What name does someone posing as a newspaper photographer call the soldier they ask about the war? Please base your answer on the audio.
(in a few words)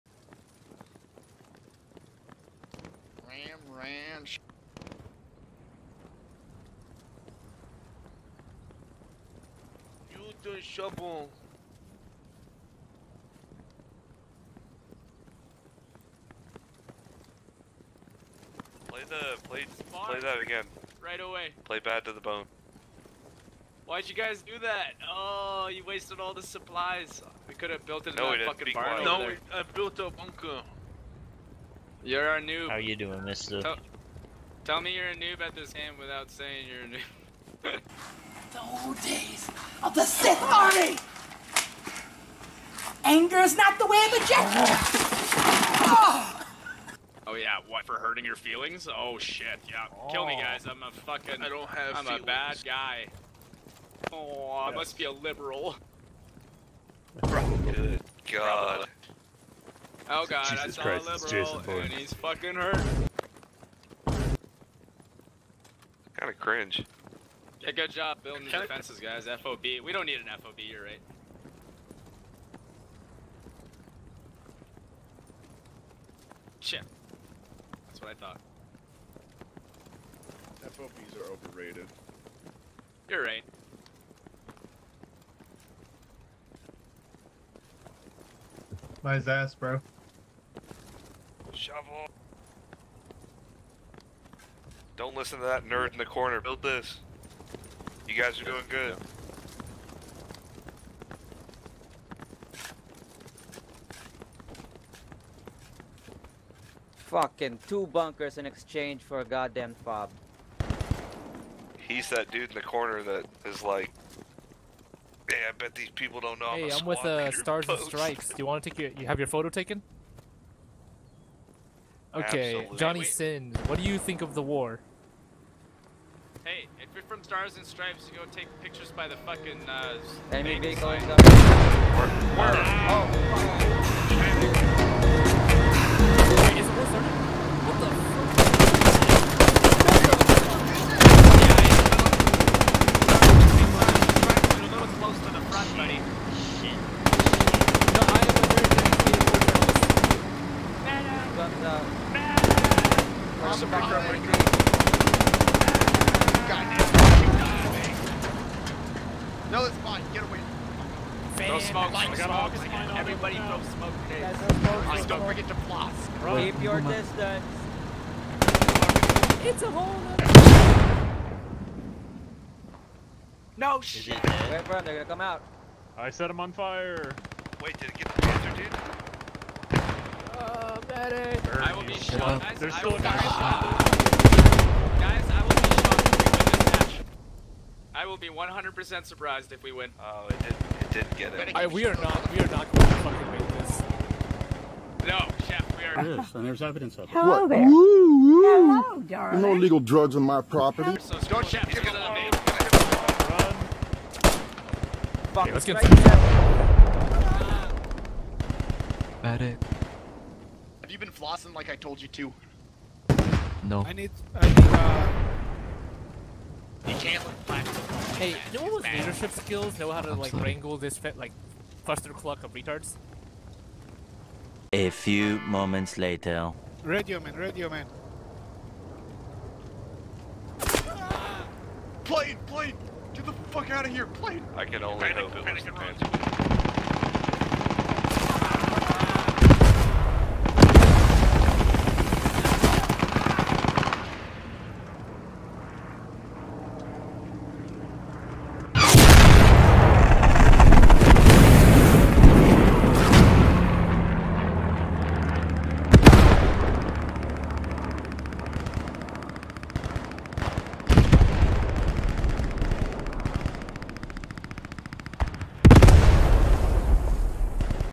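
Johnny Sin.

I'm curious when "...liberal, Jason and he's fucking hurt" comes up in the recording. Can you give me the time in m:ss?
1:01.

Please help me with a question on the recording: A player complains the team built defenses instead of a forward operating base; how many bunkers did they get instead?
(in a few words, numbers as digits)
2.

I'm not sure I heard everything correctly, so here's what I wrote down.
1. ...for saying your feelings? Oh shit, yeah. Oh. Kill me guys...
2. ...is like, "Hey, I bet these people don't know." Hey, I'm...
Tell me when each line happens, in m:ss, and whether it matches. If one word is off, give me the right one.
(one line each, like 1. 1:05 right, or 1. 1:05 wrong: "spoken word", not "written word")
1. 0:47 wrong: "hurting", not "saying"
2. 1:53 right.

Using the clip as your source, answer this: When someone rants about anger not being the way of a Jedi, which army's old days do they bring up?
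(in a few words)
Sith Army.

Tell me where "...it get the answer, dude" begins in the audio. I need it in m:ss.
2:57.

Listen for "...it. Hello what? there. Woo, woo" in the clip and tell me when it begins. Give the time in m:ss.
3:17.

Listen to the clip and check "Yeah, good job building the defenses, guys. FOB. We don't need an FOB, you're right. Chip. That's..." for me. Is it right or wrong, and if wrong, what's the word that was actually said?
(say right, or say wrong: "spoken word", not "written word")
right.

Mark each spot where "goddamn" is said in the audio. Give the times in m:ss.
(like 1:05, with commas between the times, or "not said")
1:49, 2:36.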